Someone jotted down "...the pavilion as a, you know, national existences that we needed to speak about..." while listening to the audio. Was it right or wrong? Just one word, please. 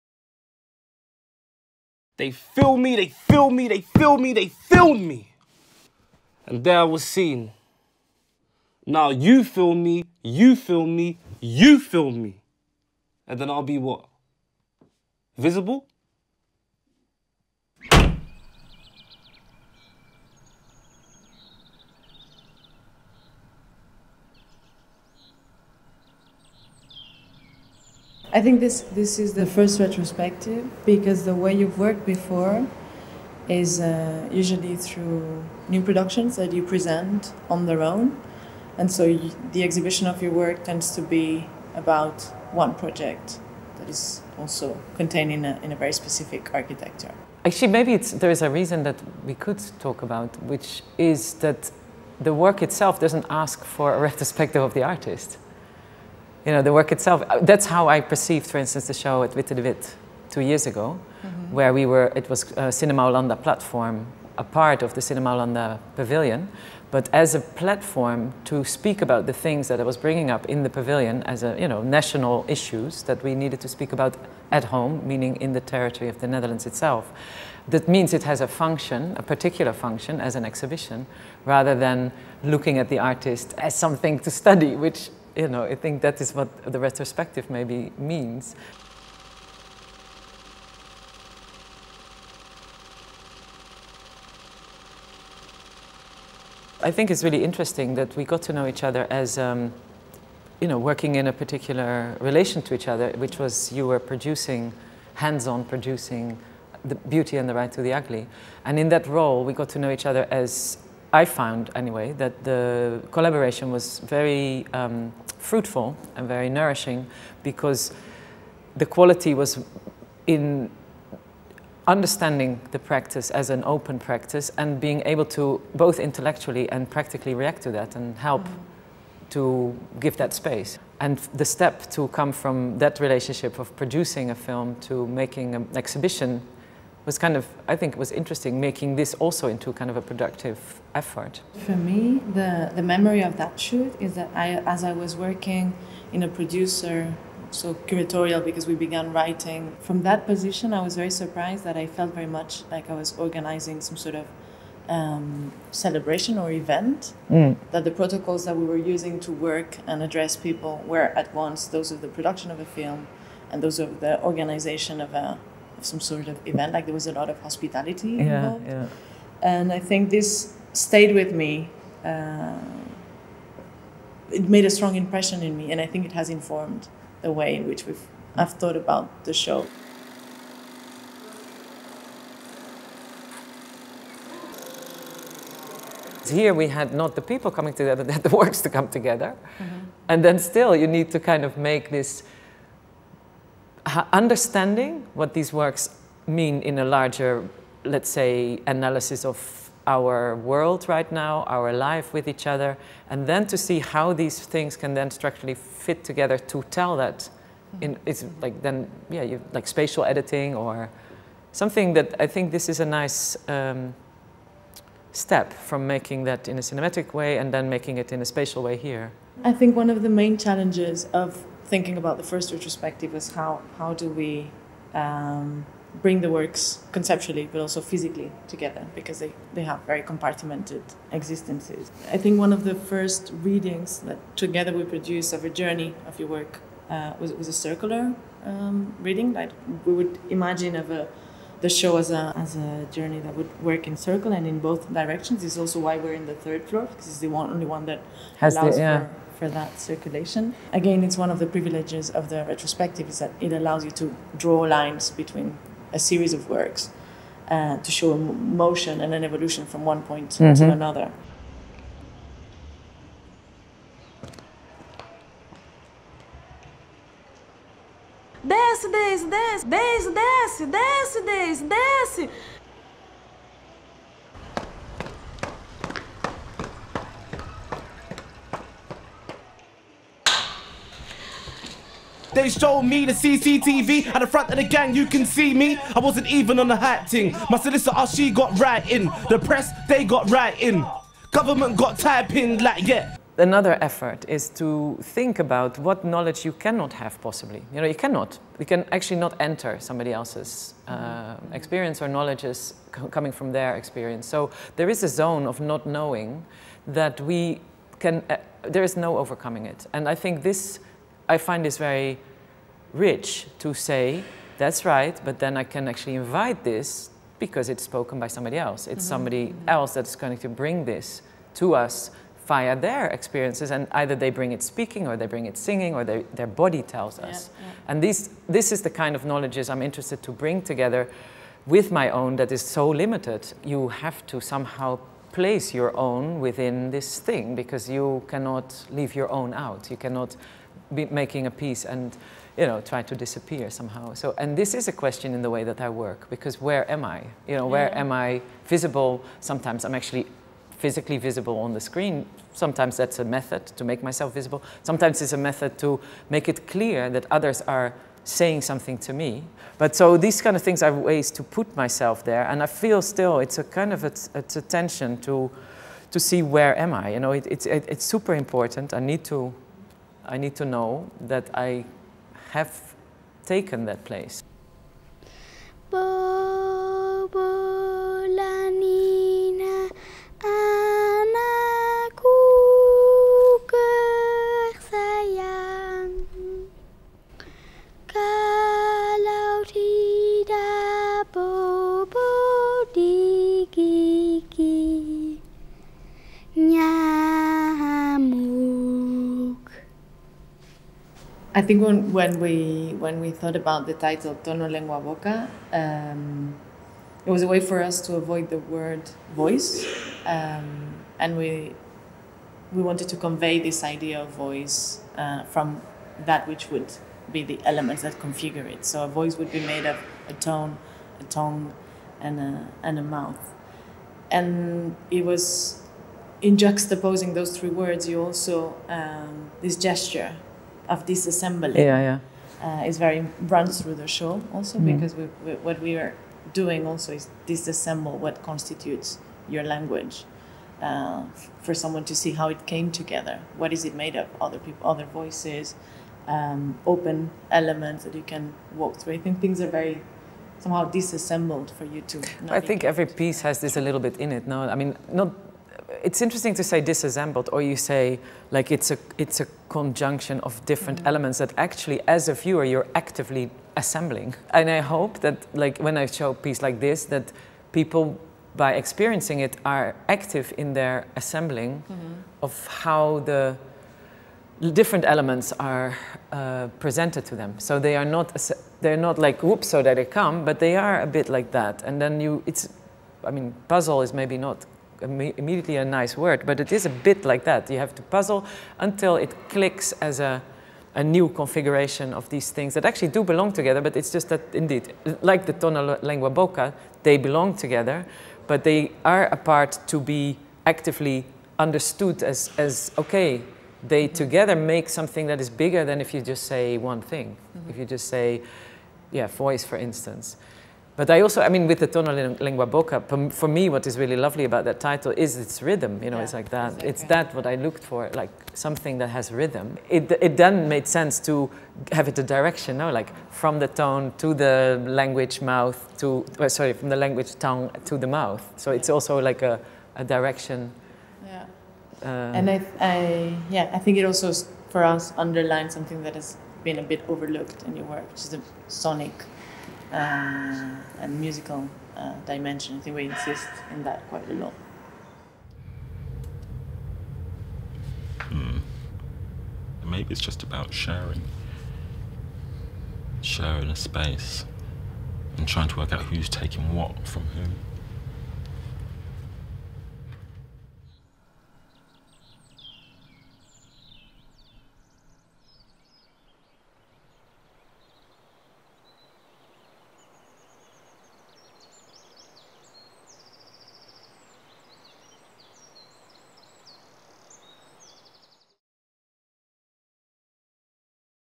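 wrong.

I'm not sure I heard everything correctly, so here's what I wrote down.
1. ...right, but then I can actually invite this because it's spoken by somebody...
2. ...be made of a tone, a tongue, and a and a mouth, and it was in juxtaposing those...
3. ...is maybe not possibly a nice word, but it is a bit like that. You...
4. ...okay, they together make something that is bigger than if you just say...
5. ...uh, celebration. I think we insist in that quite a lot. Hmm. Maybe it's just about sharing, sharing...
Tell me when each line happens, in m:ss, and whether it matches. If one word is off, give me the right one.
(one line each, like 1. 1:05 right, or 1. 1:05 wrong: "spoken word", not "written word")
1. 5:14 right
2. 6:59 right
3. 8:04 wrong: "immediately", not "possibly"
4. 8:22 right
5. 9:01 wrong: "dimension", not "celebration".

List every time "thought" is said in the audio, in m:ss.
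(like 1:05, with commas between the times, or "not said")
2:58, 6:43.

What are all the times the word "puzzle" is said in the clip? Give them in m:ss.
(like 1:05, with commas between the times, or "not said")
8:03, 8:08.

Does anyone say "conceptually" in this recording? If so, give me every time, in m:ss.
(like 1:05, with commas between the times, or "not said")
3:46.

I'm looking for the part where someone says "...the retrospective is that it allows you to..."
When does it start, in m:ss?
4:12.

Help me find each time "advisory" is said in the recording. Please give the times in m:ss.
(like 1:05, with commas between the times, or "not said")
not said.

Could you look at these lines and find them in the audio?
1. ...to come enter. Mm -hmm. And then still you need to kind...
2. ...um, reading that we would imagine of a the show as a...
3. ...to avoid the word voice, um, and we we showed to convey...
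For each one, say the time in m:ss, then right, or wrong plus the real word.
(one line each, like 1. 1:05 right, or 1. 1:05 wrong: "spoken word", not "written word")
1. 3:08 wrong: "together", not "enter"
2. 3:58 right
3. 6:48 wrong: "wanted", not "showed".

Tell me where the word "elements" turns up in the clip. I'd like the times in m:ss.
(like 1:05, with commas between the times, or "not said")
6:57, 7:27, 7:41, 7:55.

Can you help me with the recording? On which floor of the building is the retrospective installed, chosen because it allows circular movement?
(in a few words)
Third floor.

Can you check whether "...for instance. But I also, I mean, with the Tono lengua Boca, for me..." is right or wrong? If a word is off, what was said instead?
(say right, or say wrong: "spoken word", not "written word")
right.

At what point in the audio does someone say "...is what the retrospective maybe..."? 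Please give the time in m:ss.
1:26.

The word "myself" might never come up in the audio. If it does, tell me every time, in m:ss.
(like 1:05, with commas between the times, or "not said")
5:54, 6:01.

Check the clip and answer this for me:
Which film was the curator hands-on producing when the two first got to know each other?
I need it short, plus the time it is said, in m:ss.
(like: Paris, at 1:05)
The Right to the Ugly, at 1:47.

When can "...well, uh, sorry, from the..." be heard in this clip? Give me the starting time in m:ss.
8:46.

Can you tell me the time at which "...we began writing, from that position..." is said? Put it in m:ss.
2:28.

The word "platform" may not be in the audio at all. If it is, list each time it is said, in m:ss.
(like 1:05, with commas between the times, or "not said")
1:03, 1:07.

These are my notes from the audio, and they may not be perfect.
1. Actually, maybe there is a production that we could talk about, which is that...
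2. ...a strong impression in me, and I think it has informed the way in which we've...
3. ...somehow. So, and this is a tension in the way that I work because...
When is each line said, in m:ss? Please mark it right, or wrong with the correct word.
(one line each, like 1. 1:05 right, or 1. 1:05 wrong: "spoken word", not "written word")
1. 0:47 wrong: "reason", not "production"
2. 2:54 right
3. 5:43 wrong: "question", not "tension".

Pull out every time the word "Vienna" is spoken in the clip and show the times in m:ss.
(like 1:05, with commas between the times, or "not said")
not said.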